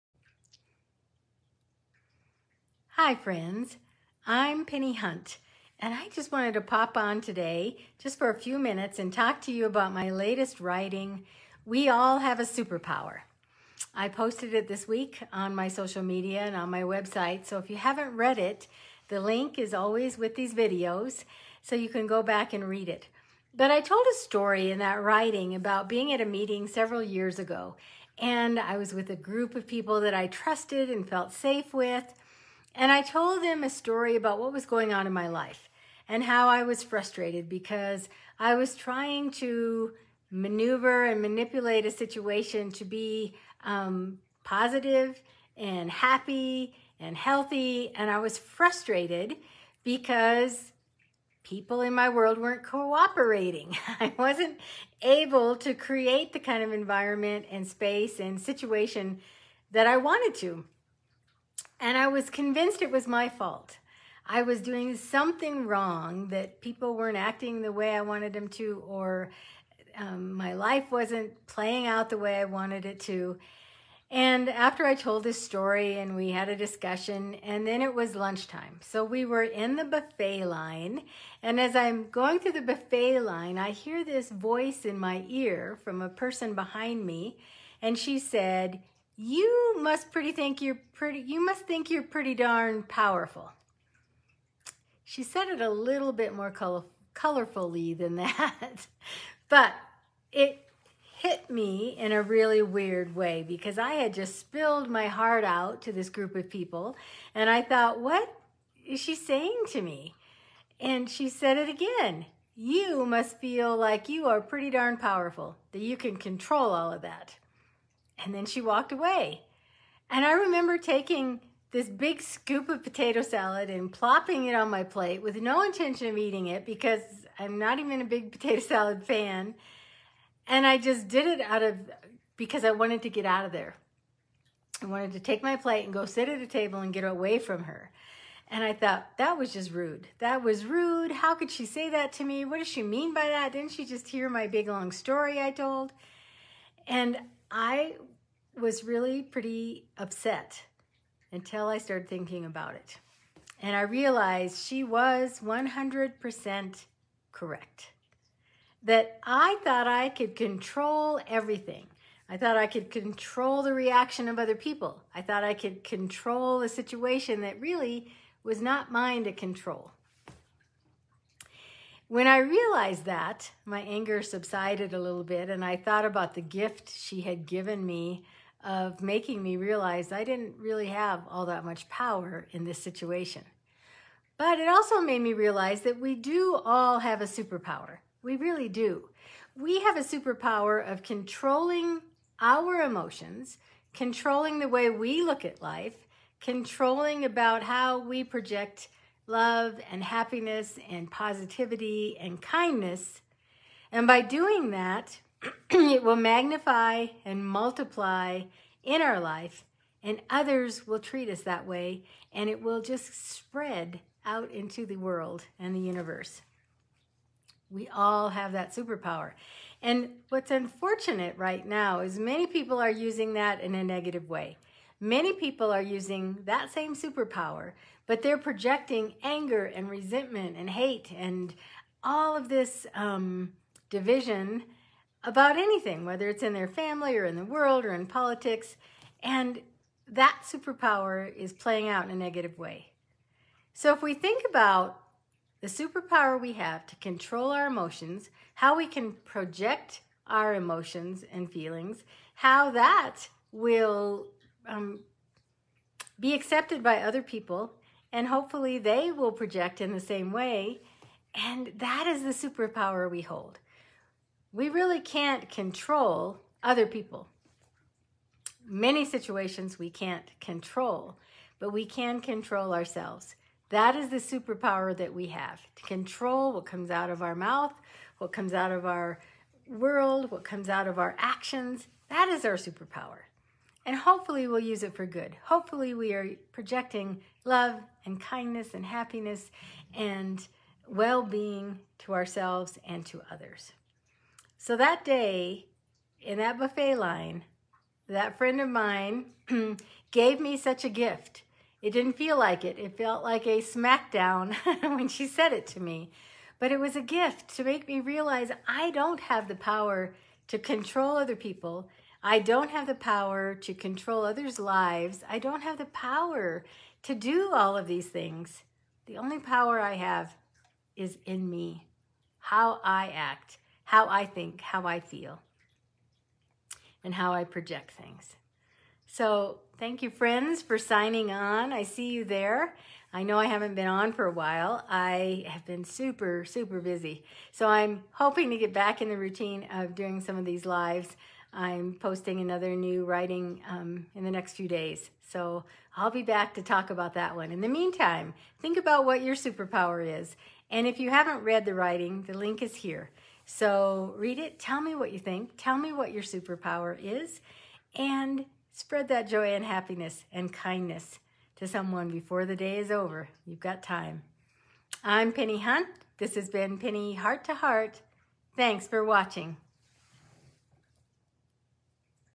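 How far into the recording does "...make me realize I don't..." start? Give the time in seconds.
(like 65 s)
307 s.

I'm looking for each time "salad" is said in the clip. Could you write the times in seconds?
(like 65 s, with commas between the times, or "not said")
123 s, 128 s.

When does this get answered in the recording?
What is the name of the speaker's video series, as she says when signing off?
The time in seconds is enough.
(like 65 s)
366 s.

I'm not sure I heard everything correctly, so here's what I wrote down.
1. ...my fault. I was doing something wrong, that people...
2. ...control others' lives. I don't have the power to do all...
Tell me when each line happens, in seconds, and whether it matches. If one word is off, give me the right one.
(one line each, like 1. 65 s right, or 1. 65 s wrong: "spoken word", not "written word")
1. 63 s right
2. 313 s right.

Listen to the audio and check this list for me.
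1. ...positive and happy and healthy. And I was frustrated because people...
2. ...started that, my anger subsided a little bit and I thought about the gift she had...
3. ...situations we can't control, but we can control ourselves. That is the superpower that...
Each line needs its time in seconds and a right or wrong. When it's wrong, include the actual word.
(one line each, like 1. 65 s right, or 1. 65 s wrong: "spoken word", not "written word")
1. 44 s right
2. 172 s wrong: "realized", not "started"
3. 269 s right.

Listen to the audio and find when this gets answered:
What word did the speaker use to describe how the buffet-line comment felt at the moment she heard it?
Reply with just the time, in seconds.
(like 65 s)
303 s.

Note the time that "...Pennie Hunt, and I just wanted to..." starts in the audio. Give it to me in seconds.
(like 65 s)
4 s.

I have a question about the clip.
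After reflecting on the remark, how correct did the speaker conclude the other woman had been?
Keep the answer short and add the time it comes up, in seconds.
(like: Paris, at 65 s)
100%, at 155 s.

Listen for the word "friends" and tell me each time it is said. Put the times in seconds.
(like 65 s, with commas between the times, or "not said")
3 s, 298 s, 330 s.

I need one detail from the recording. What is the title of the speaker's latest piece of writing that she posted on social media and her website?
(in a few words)
We All Have a Superpower.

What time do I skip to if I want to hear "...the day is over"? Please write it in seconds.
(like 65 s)
362 s.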